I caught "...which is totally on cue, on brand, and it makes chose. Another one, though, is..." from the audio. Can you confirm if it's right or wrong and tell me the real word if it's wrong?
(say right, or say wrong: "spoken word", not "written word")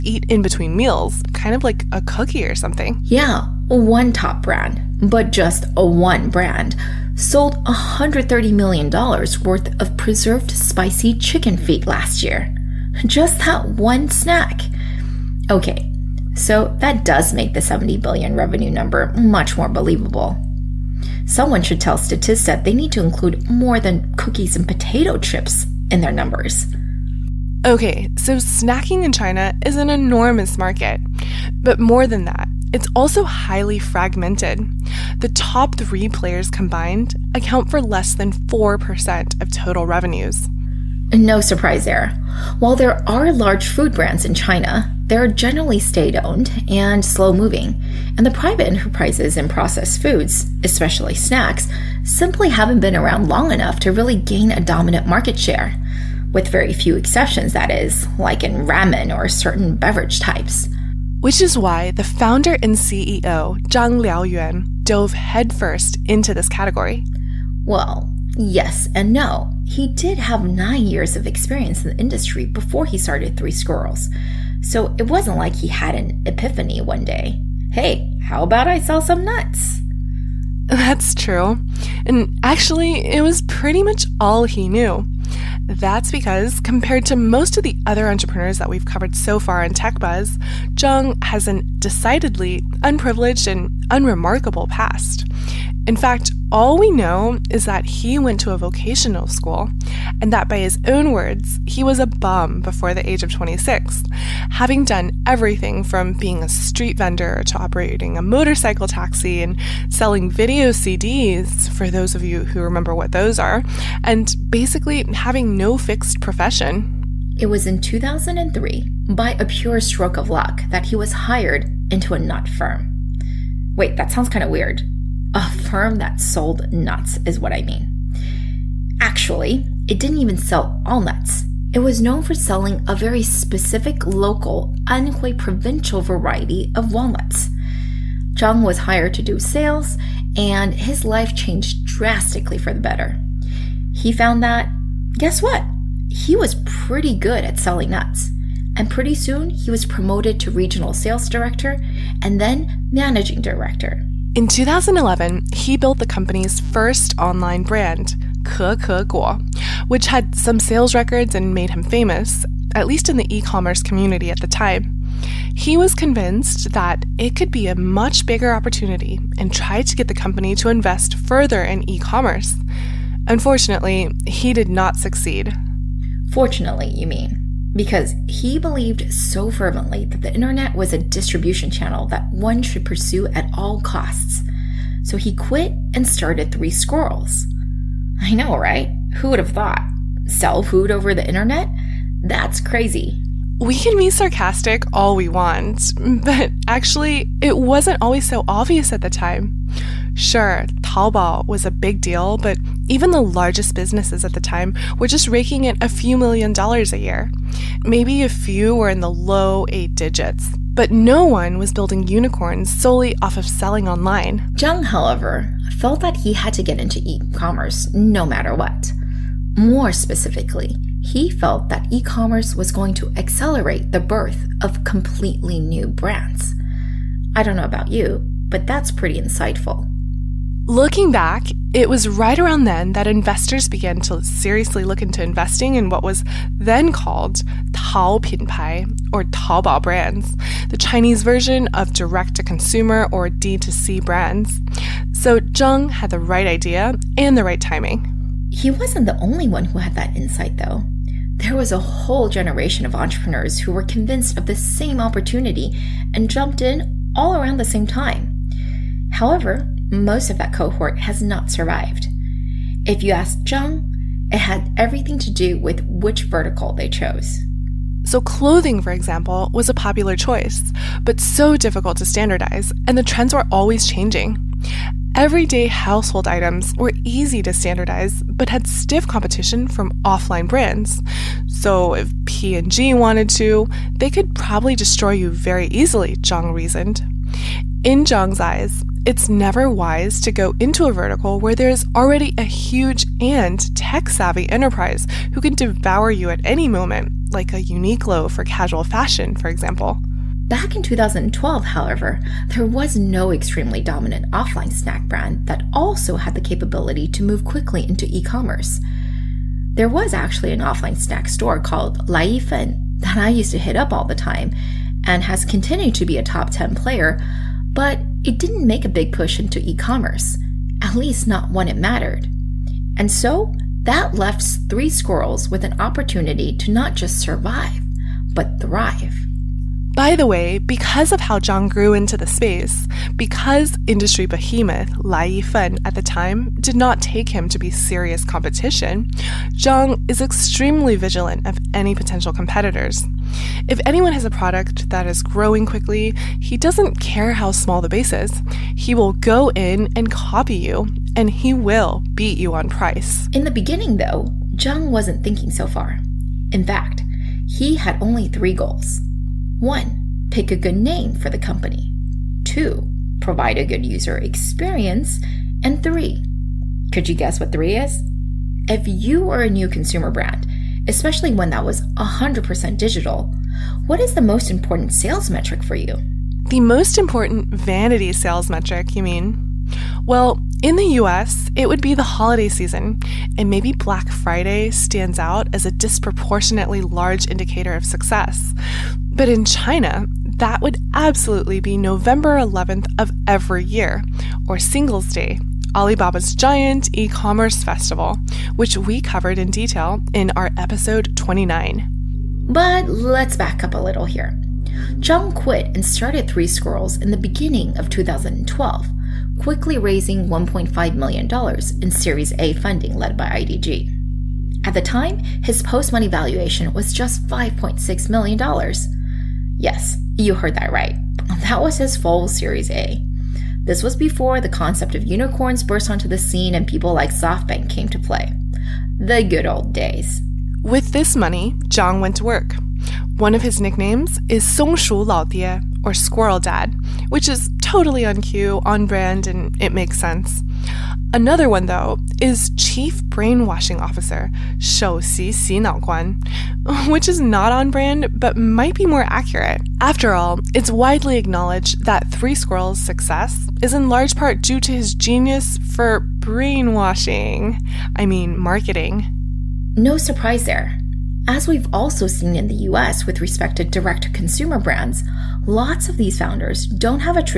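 wrong: "sense", not "chose".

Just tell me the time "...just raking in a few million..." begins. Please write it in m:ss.
3:25.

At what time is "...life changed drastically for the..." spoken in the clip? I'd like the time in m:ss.
2:21.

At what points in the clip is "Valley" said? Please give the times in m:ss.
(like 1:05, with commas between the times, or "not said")
not said.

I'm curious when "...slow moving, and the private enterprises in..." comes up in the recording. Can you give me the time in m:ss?
0:47.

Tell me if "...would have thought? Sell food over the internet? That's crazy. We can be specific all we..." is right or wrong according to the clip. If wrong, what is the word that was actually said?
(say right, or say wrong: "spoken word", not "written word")
wrong: "sarcastic", not "specific".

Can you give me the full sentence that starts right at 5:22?
And so that left Three Squirrels with an opportunity to not just survive, but thrive.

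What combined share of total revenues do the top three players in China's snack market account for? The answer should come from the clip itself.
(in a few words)
less than 4%.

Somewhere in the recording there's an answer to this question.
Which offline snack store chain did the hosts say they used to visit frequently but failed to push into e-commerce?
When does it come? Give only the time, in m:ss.
5:12.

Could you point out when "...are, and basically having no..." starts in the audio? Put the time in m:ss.
1:53.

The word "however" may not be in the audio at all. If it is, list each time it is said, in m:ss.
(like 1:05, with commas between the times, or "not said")
3:34, 4:19, 5:01.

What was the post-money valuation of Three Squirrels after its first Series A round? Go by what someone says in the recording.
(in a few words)
$5.6 million.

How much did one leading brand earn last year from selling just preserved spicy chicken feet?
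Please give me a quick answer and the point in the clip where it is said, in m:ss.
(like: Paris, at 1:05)
$130 million, at 0:07.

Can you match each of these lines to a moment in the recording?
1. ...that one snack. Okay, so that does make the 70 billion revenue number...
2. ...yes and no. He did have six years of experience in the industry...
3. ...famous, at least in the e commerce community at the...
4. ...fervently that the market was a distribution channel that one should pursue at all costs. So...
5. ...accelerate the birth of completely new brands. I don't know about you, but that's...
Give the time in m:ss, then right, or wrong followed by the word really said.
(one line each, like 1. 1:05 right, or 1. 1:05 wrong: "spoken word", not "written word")
1. 0:13 right
2. 1:08 wrong: "nine", not "six"
3. 2:41 right
4. 2:59 wrong: "internet", not "market"
5. 3:43 right.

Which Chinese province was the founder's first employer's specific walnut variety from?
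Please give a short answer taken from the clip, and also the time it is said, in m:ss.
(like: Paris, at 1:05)
Anhui, at 2:14.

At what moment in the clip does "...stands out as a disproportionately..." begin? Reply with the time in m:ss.
6:24.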